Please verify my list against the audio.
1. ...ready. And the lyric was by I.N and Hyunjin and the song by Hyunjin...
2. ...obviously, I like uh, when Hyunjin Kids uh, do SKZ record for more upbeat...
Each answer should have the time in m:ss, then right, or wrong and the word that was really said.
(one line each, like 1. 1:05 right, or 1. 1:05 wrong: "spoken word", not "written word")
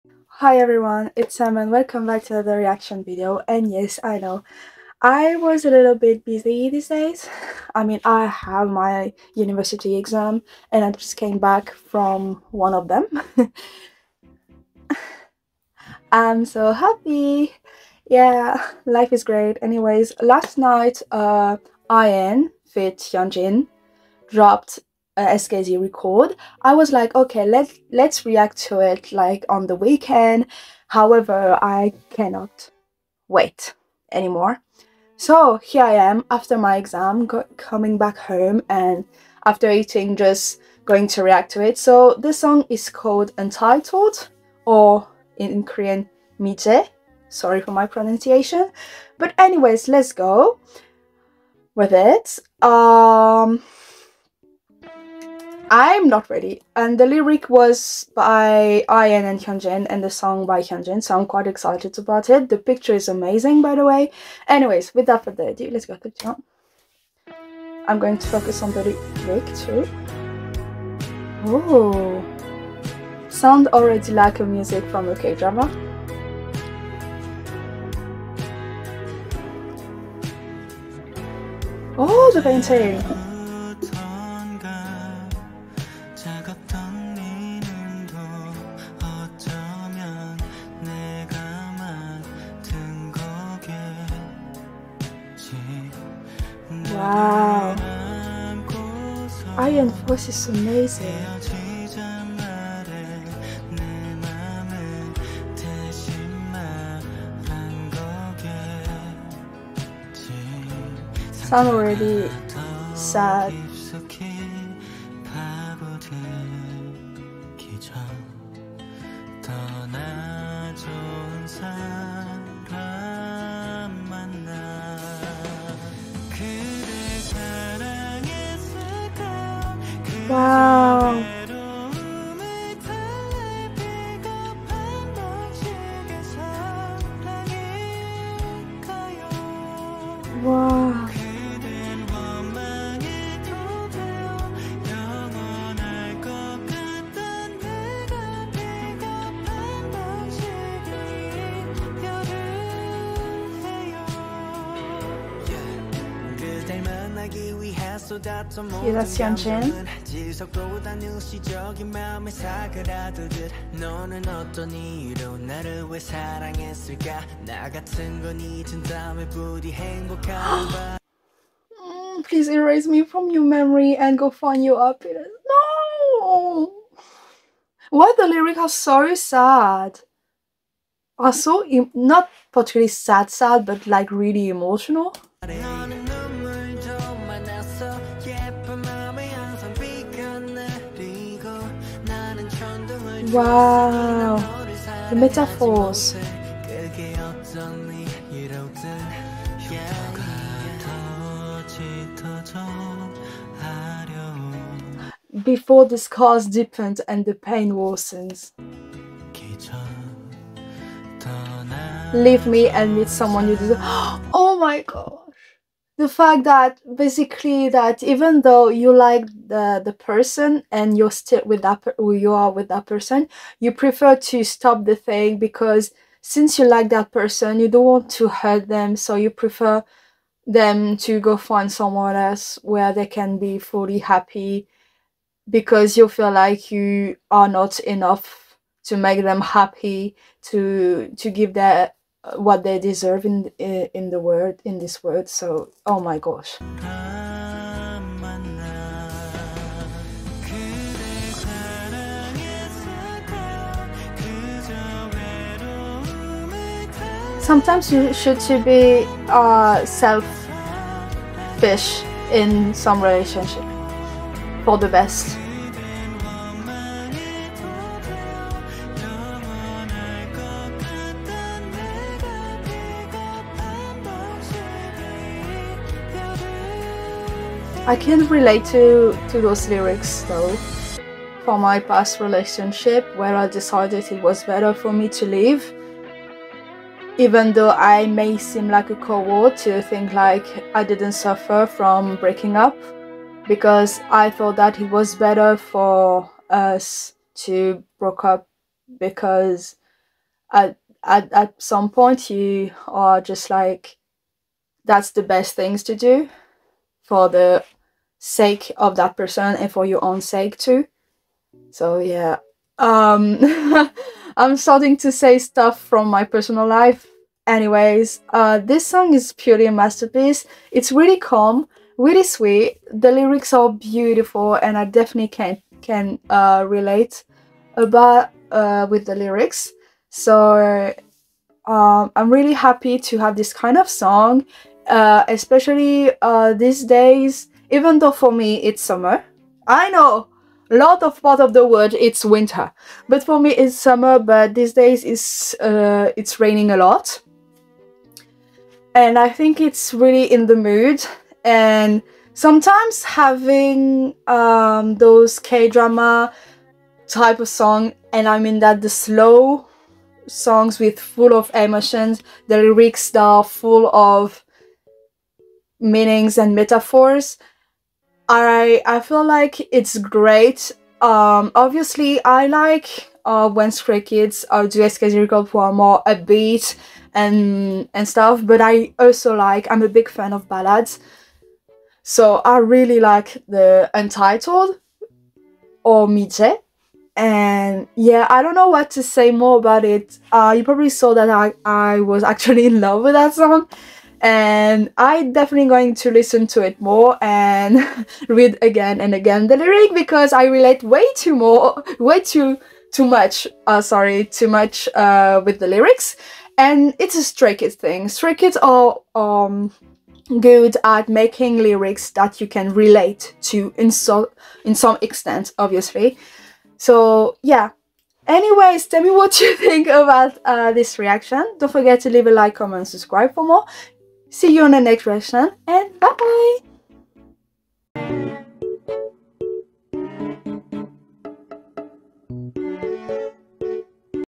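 1. 0:56 right
2. 6:11 wrong: "Stray", not "Hyunjin".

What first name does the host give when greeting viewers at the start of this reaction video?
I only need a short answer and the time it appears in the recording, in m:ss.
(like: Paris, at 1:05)
Sam, at 0:01.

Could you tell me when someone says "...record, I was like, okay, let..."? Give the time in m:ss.
0:25.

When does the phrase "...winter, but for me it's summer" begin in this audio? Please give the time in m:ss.
5:42.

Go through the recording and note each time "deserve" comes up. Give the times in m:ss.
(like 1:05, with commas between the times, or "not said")
3:33, 4:02.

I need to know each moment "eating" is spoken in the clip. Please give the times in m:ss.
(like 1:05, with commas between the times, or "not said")
0:39.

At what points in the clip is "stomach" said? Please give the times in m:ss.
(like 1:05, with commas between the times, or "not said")
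not said.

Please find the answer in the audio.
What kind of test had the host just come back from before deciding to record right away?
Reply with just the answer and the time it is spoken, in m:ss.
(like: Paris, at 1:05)
University exam, at 0:09.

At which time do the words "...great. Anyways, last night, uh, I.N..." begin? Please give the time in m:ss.
0:19.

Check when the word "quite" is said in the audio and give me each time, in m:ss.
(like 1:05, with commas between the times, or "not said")
1:01.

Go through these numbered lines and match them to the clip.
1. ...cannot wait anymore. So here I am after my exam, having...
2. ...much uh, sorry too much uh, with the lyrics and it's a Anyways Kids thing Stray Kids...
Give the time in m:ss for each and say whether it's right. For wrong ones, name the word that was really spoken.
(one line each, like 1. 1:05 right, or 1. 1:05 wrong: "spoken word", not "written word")
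1. 0:32 wrong: "coming", not "having"
2. 6:43 wrong: "Stray", not "Anyways".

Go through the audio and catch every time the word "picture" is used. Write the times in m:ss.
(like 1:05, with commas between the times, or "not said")
1:02.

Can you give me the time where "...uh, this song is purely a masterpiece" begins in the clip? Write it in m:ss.
5:18.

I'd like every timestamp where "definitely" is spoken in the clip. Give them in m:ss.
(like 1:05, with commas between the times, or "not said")
5:24, 6:35.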